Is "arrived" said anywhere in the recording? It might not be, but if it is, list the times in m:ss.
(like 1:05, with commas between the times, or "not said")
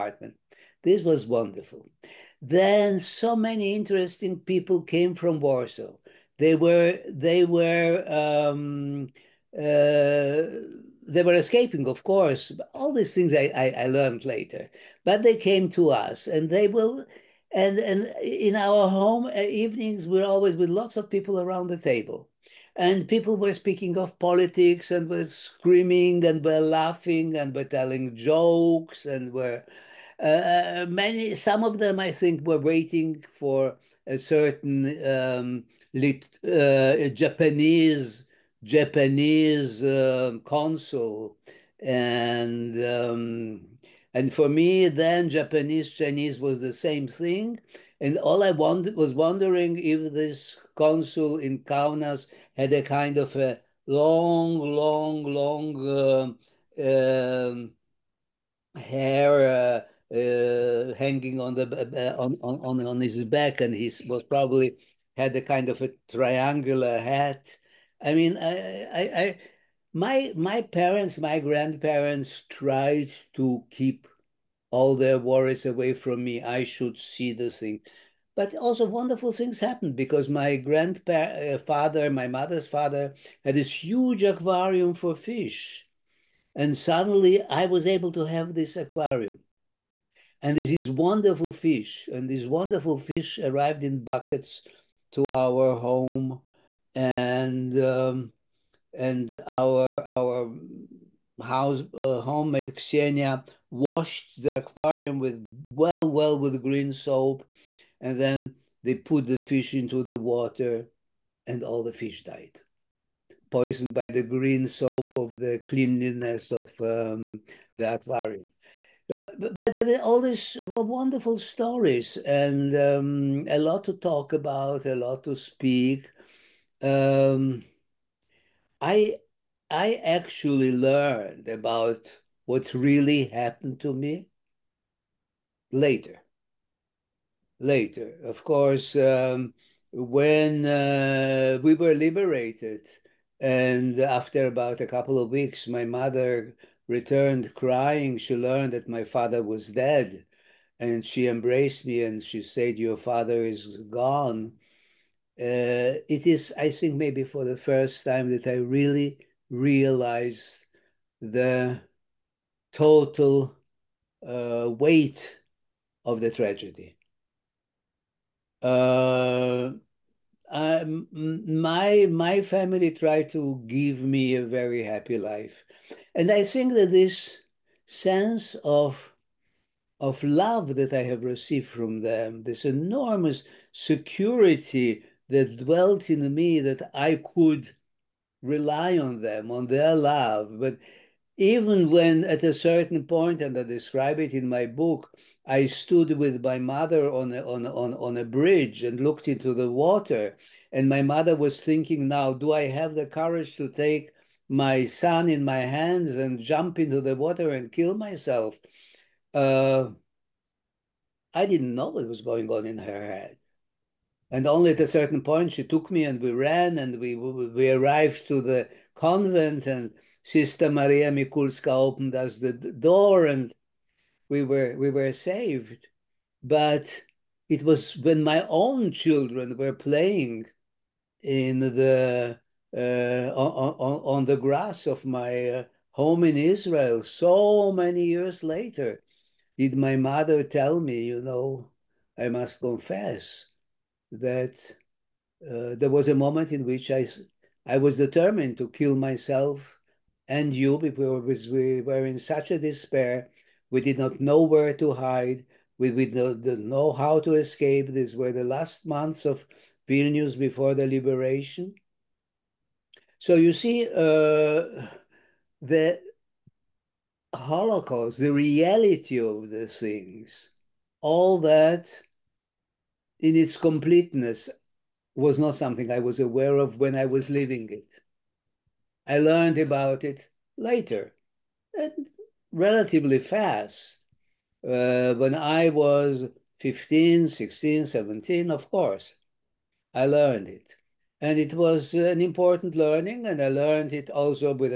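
1:33, 3:37.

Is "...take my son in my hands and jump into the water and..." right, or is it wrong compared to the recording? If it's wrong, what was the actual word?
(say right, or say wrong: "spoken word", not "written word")
right.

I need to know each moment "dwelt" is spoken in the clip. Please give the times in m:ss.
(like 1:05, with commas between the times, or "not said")
3:05.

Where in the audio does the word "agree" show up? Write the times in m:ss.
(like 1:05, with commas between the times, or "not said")
not said.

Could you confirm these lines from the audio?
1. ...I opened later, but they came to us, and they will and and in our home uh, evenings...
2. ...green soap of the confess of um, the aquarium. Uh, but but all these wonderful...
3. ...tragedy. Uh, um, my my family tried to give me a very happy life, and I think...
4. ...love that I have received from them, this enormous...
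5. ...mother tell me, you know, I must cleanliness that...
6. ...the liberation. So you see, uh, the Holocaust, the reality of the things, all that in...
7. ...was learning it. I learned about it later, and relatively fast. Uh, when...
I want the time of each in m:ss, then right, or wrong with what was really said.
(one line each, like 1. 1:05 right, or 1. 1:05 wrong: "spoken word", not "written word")
1. 0:13 wrong: "learned", not "opened"
2. 1:54 wrong: "cleanliness", not "confess"
3. 2:46 right
4. 3:00 right
5. 3:59 wrong: "confess", not "cleanliness"
6. 4:20 right
7. 4:37 wrong: "living", not "learning".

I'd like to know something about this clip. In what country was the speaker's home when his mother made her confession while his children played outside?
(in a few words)
Israel.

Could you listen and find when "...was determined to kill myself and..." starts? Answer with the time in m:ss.
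4:07.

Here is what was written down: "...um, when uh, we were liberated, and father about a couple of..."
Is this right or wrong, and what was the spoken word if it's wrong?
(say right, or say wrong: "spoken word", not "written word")
wrong: "after", not "father".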